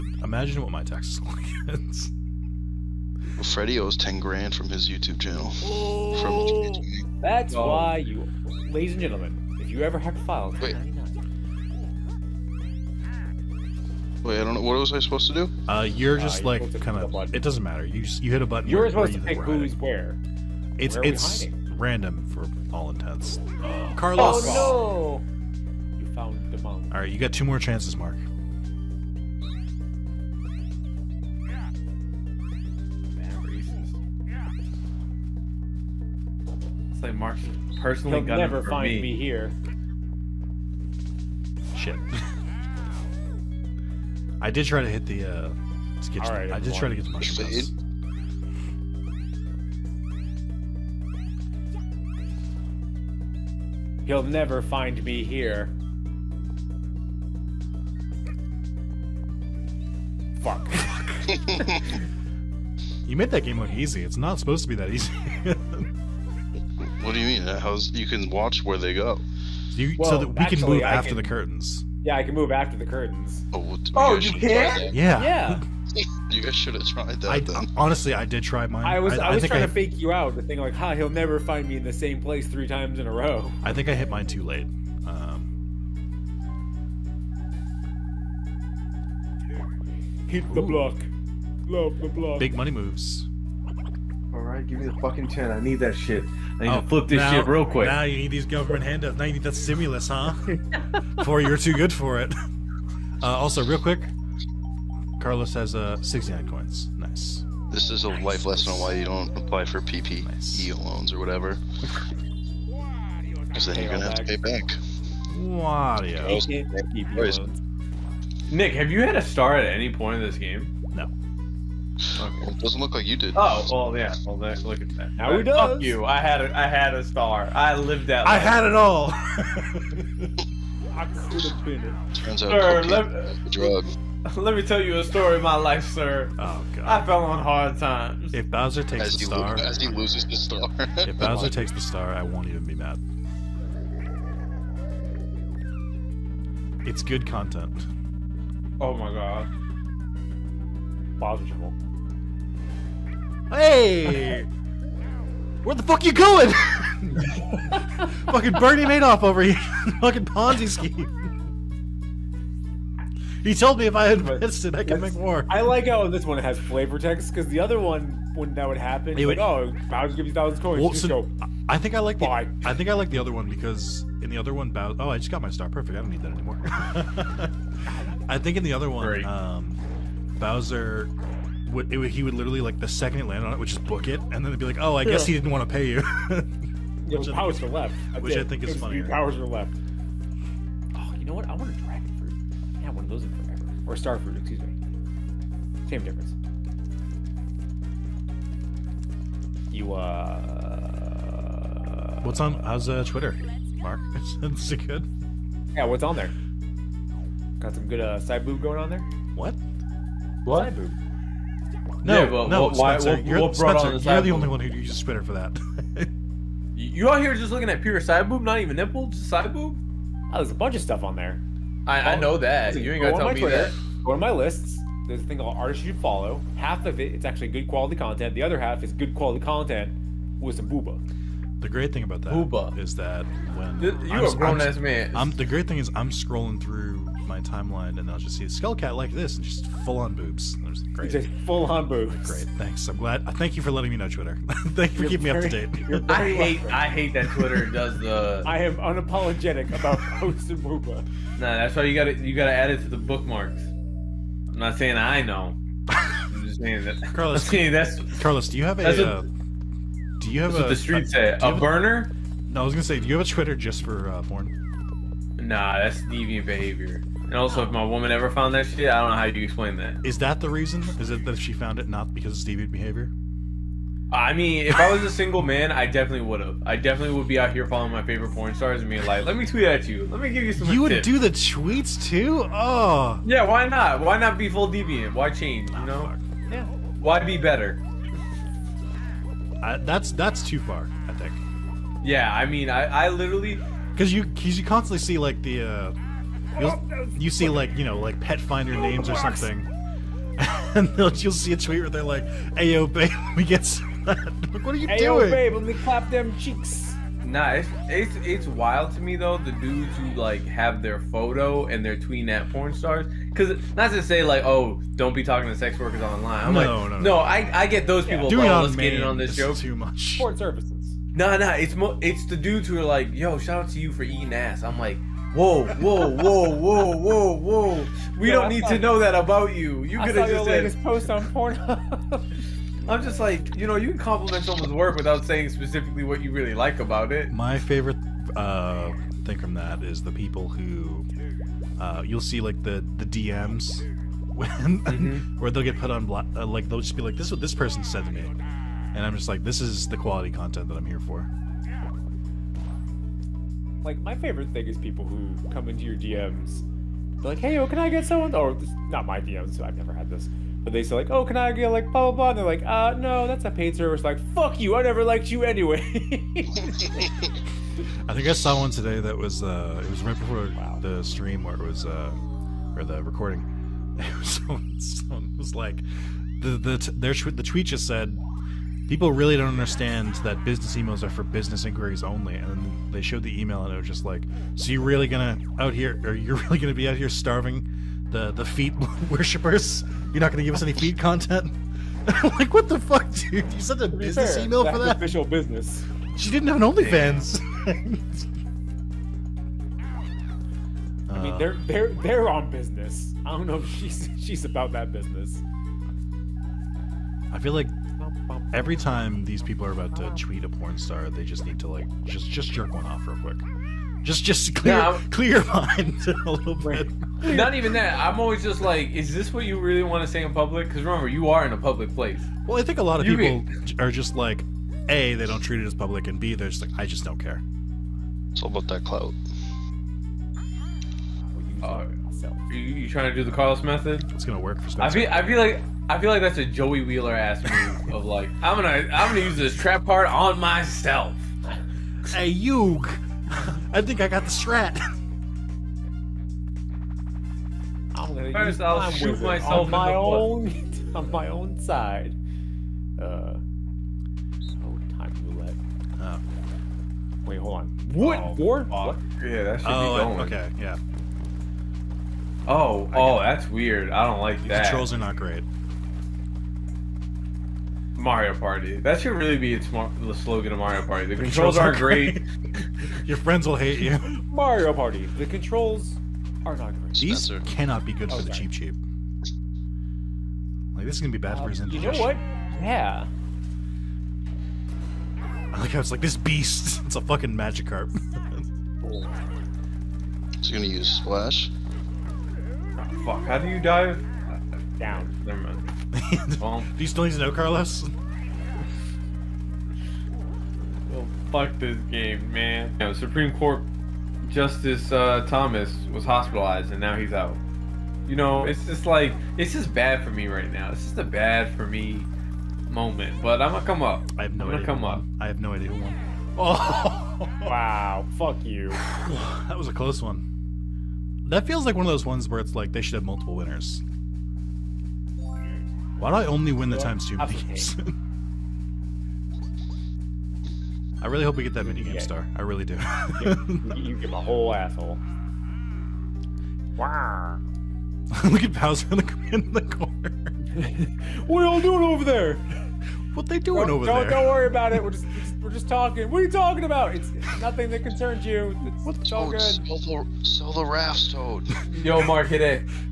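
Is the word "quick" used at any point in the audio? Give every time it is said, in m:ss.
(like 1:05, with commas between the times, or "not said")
1:37, 1:43, 6:53.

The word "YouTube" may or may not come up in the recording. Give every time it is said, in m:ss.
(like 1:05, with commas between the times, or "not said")
0:04.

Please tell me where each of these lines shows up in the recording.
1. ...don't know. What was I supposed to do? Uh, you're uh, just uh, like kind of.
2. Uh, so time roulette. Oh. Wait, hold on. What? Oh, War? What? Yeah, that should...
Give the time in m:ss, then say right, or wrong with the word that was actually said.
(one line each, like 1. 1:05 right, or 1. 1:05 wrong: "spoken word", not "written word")
1. 0:14 right
2. 7:32 right.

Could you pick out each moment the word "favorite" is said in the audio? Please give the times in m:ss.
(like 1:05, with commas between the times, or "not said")
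4:38, 5:37, 5:54.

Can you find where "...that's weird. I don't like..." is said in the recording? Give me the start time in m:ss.
7:43.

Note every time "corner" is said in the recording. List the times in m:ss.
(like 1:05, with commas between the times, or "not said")
8:59.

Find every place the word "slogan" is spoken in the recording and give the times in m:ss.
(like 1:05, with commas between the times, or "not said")
7:50.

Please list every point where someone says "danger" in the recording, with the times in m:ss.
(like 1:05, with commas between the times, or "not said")
not said.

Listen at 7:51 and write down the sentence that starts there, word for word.
The, the controls, controls, aren't great.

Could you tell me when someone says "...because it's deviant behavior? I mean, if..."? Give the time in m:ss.
4:32.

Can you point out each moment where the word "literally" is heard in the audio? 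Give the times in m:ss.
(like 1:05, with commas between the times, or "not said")
3:02, 4:53.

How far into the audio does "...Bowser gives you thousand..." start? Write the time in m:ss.
2:49.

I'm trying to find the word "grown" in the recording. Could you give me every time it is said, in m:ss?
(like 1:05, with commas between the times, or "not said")
3:54.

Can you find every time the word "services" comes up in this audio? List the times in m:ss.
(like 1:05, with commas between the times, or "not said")
5:20, 6:03.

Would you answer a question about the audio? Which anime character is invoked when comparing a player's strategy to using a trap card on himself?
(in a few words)
Joey Wheeler.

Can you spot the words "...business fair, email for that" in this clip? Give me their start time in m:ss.
6:33.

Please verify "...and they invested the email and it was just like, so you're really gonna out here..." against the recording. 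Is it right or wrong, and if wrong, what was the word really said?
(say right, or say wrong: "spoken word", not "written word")
wrong: "showed", not "invested".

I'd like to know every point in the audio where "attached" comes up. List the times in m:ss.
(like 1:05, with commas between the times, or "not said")
not said.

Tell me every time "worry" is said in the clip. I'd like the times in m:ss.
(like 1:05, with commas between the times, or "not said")
9:04.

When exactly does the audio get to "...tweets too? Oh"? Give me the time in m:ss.
4:41.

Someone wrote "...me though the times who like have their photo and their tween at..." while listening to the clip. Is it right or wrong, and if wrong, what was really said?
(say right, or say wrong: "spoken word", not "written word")
wrong: "dudes", not "times".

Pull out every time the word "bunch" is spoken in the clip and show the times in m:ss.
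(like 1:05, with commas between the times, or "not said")
3:40.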